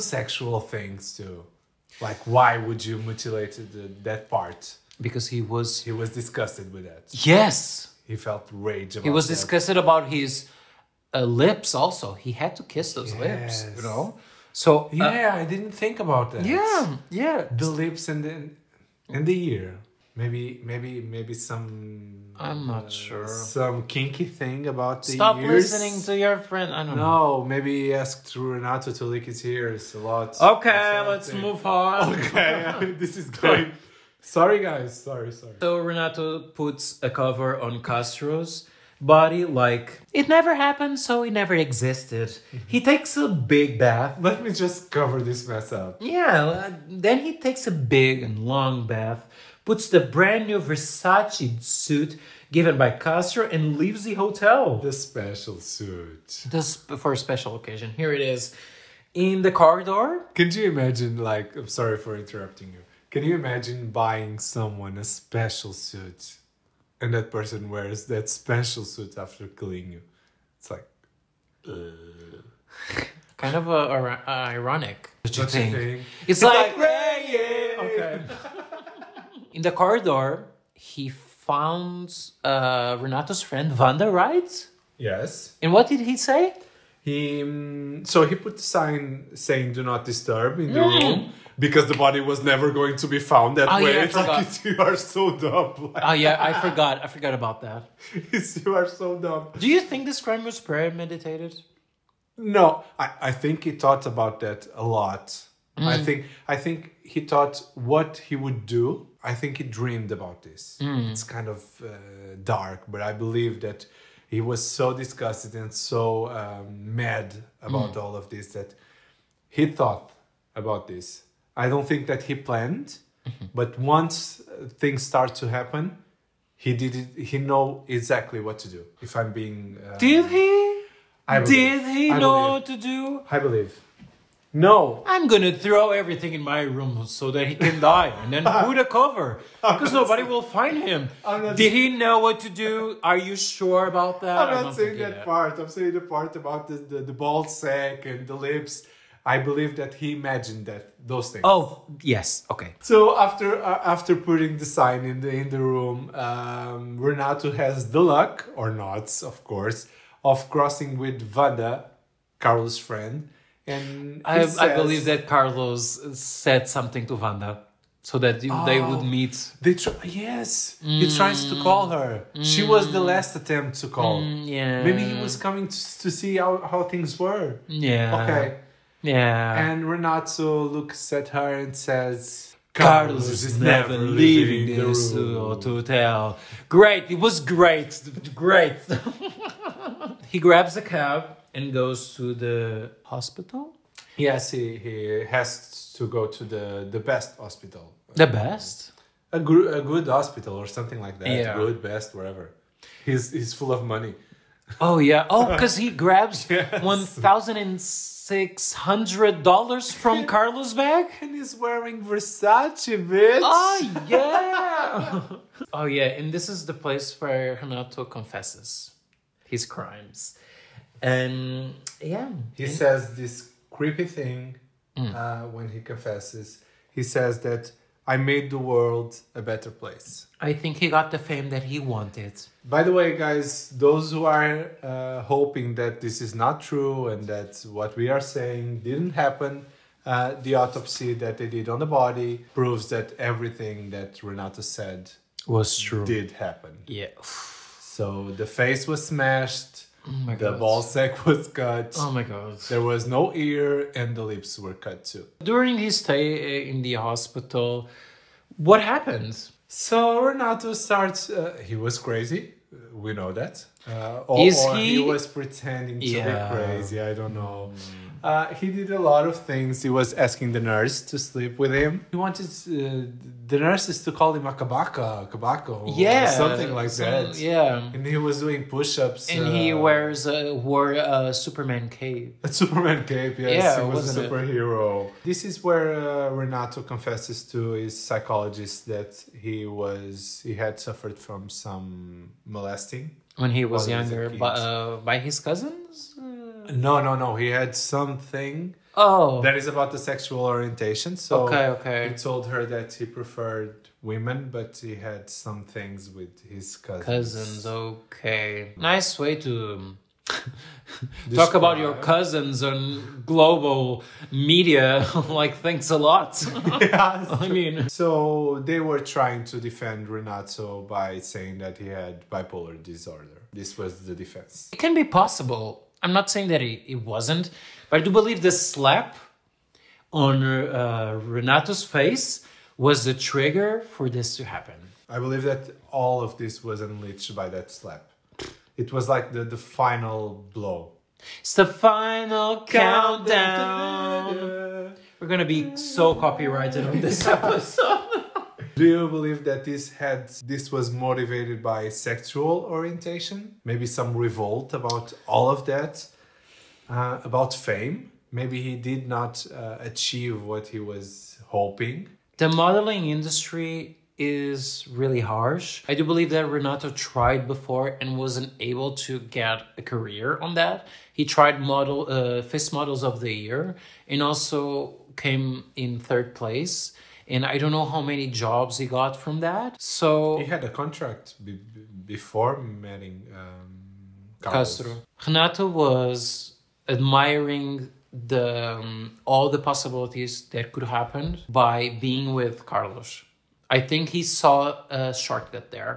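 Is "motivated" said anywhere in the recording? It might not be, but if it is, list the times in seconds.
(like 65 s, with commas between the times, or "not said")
350 s.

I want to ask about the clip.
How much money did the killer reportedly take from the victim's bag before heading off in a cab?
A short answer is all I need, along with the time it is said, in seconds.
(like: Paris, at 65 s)
$1,600, at 206 s.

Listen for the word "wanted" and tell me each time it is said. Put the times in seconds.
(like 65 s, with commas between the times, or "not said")
231 s, 272 s.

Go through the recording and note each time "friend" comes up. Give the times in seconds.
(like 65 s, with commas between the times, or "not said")
26 s, 83 s, 162 s.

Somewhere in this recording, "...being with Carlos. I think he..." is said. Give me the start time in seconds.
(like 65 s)
392 s.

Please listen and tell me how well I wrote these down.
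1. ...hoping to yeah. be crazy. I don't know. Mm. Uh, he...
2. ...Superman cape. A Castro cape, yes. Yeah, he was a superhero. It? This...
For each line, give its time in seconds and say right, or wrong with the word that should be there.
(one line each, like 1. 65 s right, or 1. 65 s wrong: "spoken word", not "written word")
1. 265 s wrong: "pretending", not "hoping"
2. 281 s wrong: "Superman", not "Castro".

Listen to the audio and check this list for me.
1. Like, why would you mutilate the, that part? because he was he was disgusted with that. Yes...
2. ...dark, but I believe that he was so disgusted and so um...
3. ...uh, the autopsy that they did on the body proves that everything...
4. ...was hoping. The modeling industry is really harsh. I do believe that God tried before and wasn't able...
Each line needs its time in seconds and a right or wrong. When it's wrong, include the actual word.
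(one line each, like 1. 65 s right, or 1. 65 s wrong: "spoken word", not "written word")
1. 2 s right
2. 112 s right
3. 240 s right
4. 360 s wrong: "Renato", not "God".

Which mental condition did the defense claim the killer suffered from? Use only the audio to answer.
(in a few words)
bipolar disorder.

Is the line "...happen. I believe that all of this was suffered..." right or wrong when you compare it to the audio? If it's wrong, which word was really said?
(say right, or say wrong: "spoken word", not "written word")
wrong: "unleashed", not "suffered".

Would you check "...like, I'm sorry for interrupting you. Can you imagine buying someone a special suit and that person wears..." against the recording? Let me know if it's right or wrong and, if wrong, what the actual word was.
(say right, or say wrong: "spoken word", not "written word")
right.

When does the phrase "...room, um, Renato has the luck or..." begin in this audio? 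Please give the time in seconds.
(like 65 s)
155 s.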